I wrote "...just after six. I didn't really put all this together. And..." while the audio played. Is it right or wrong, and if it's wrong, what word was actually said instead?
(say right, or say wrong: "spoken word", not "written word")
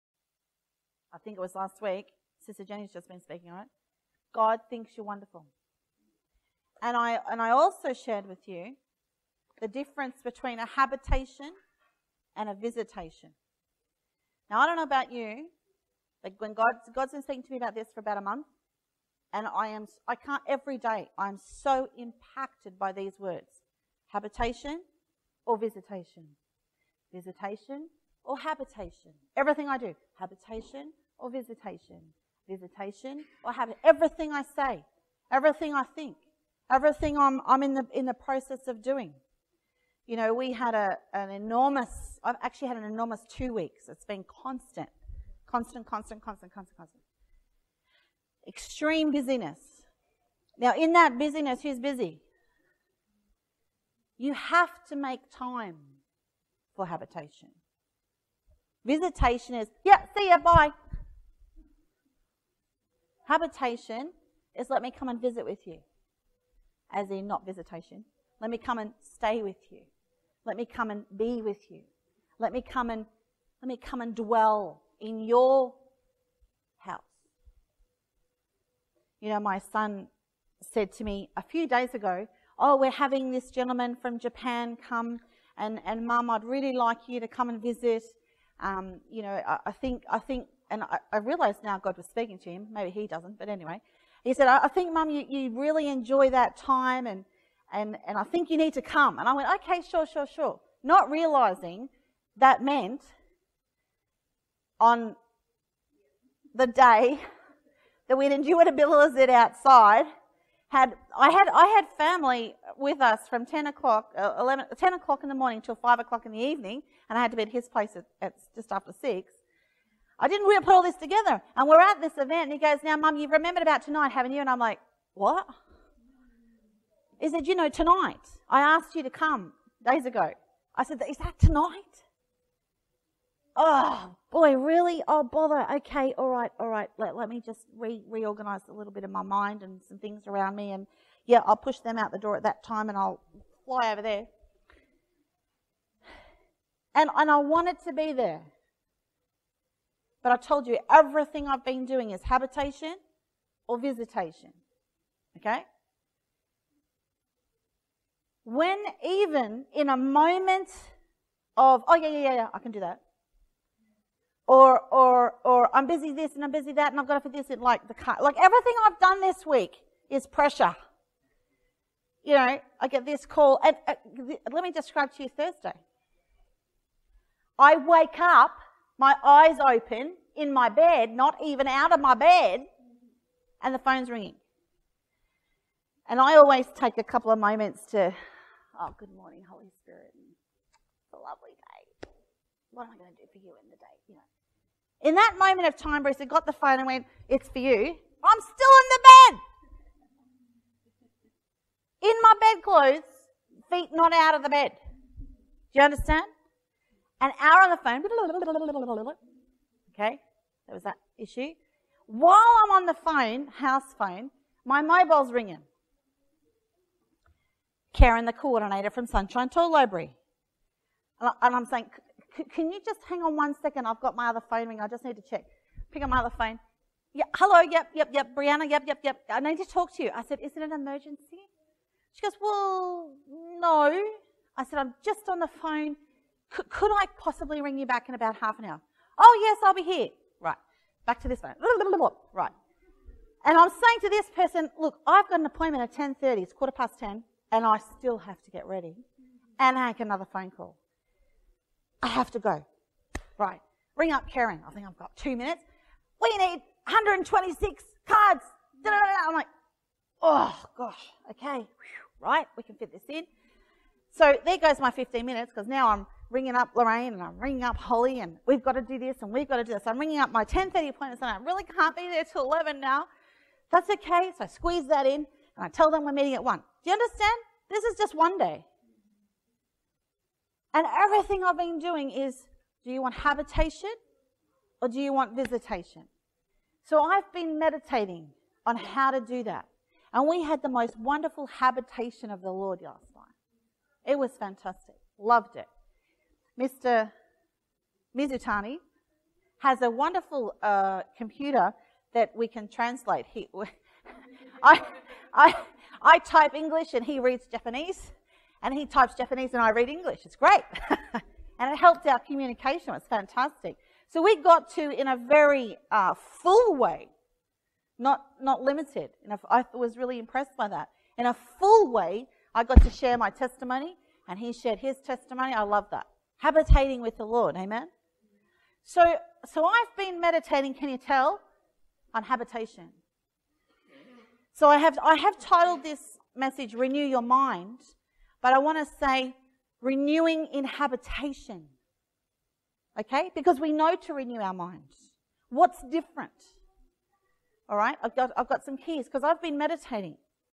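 right.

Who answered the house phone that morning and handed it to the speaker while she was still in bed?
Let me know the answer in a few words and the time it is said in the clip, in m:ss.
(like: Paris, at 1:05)
Bruce, at 3:16.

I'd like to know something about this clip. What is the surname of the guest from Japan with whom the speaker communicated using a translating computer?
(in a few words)
Mizutani.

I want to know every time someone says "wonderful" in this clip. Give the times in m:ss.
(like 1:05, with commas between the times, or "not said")
0:05, 4:50, 4:59.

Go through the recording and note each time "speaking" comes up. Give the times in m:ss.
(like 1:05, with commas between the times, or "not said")
0:03, 0:17, 1:32.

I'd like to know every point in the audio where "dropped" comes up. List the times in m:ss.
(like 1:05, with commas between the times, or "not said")
not said.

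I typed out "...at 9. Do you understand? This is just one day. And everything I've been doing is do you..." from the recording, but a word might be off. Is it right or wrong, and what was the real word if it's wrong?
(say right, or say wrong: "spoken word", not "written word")
wrong: "1", not "9".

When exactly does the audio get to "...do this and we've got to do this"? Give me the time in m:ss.
4:28.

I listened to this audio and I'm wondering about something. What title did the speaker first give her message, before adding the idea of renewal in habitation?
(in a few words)
Renew Your Mind.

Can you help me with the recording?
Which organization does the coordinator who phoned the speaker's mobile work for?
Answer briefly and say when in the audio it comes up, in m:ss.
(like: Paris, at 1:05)
Sunshine Tool Library, at 3:39.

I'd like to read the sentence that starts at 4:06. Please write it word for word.
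It's quarter past 10 and I still have to get ready and make another phone call.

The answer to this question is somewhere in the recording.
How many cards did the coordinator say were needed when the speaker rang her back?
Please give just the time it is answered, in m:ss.
4:16.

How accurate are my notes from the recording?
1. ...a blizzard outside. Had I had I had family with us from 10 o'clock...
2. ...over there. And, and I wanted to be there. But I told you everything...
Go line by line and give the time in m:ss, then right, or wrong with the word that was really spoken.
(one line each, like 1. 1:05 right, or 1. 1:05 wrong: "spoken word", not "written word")
1. 1:48 right
2. 2:23 right.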